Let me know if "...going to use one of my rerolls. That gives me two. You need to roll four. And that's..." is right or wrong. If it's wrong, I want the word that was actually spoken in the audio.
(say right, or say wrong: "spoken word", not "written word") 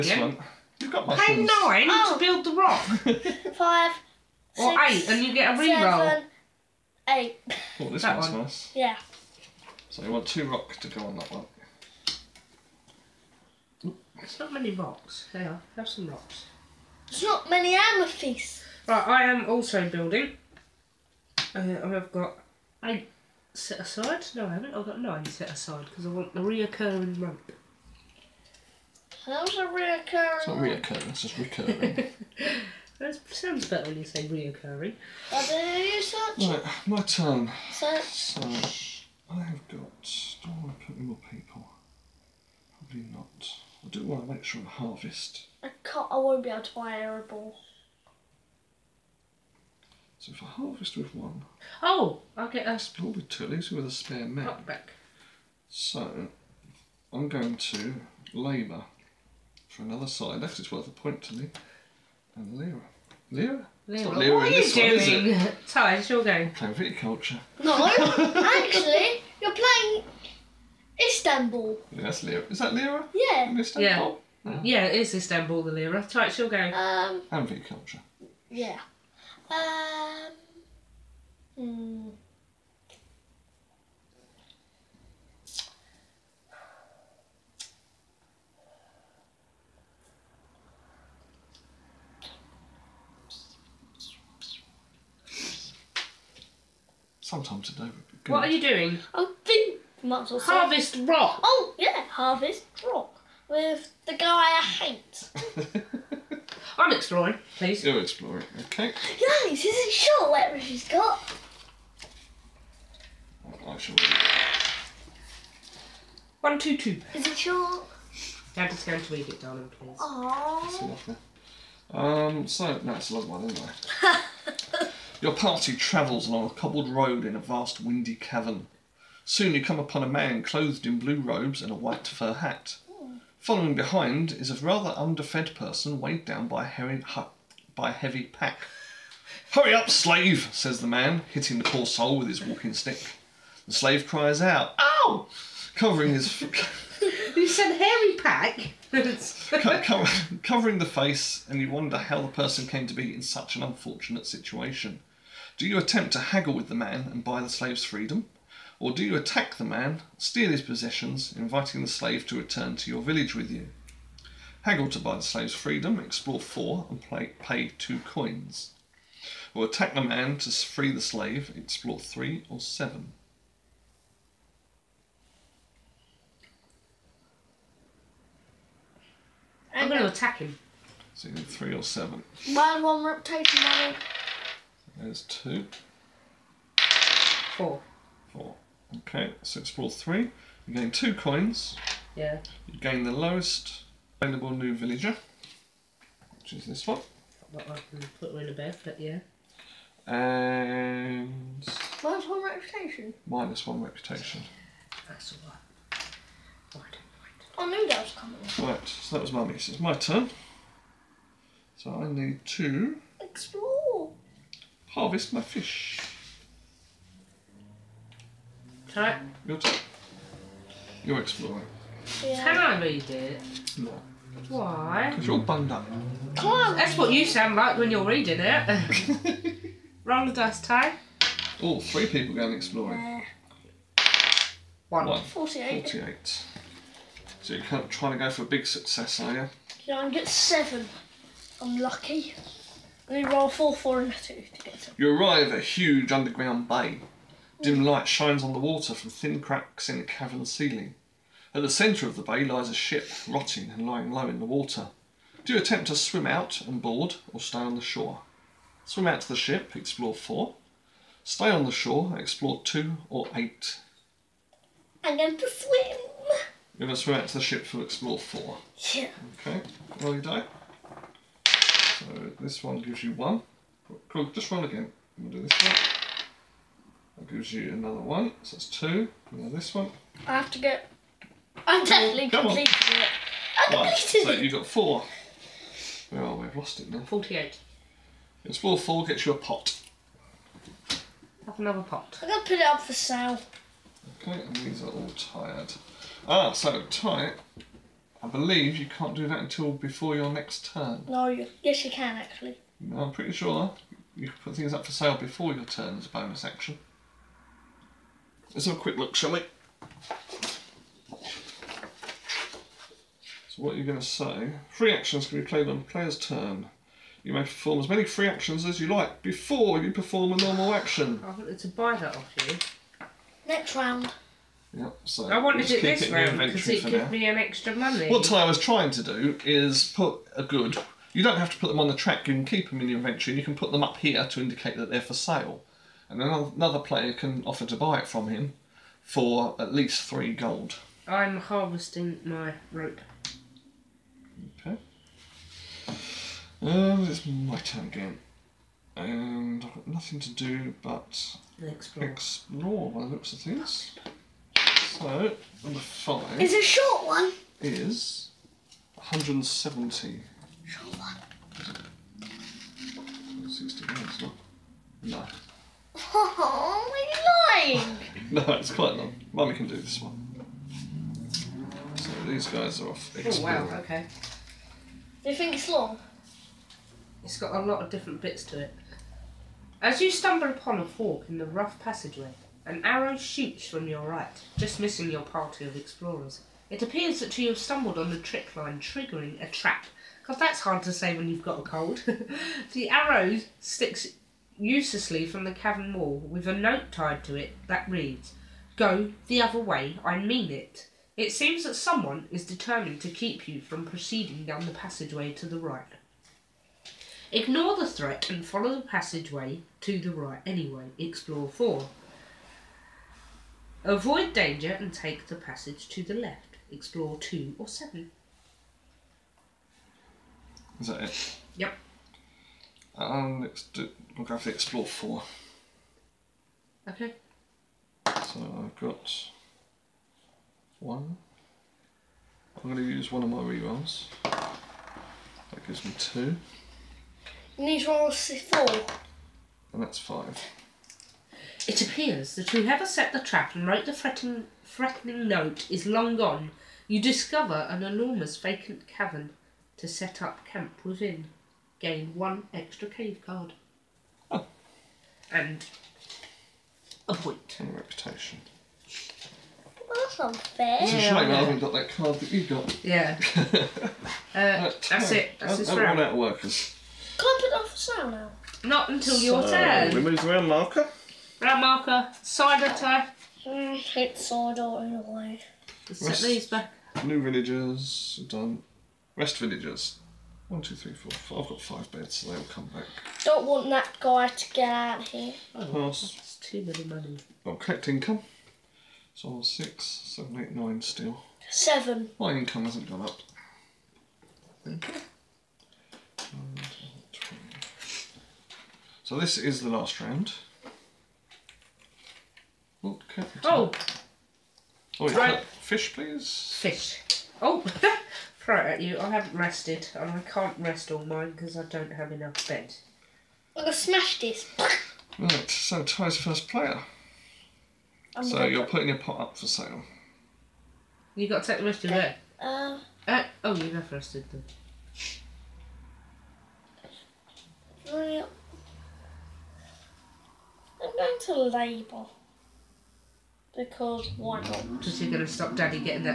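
right.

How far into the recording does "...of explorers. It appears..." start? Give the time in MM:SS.
06:25.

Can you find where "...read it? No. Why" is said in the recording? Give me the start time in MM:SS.
03:42.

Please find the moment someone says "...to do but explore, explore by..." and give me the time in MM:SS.
05:50.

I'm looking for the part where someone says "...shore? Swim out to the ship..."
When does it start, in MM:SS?
04:17.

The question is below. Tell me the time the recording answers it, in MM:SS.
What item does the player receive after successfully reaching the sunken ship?
04:49.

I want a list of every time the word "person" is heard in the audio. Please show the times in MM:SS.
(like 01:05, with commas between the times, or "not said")
02:15, 02:32.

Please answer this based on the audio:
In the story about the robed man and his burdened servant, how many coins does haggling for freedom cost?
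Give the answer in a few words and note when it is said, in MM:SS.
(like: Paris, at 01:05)
2, at 02:47.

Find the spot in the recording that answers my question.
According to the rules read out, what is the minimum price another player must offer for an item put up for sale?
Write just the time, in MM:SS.
05:40.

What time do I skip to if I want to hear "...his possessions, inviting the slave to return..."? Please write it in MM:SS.
02:40.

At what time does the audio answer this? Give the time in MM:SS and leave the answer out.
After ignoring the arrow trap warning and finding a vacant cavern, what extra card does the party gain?
07:32.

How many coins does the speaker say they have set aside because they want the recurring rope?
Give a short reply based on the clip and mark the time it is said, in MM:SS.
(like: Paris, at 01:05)
9, at 00:24.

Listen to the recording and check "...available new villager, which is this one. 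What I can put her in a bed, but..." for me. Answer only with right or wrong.
right.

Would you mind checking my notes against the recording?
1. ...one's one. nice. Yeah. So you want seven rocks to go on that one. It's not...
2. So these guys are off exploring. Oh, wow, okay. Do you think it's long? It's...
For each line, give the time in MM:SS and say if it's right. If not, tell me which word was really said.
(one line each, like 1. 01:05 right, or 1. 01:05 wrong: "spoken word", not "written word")
1. 00:08 wrong: "two", not "seven"
2. 06:11 right.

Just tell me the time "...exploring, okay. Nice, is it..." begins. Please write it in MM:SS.
01:47.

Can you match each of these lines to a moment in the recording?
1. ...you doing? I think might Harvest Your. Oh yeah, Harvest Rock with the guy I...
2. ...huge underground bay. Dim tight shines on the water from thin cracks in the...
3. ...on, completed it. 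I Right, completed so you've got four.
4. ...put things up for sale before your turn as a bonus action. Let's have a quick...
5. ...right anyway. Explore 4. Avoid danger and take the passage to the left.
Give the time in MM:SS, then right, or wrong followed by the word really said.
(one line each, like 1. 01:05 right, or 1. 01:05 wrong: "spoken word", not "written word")
1. 01:38 wrong: "Rock", not "Your"
2. 04:05 wrong: "light", not "tight"
3. 04:42 right
4. 05:04 right
5. 06:50 right.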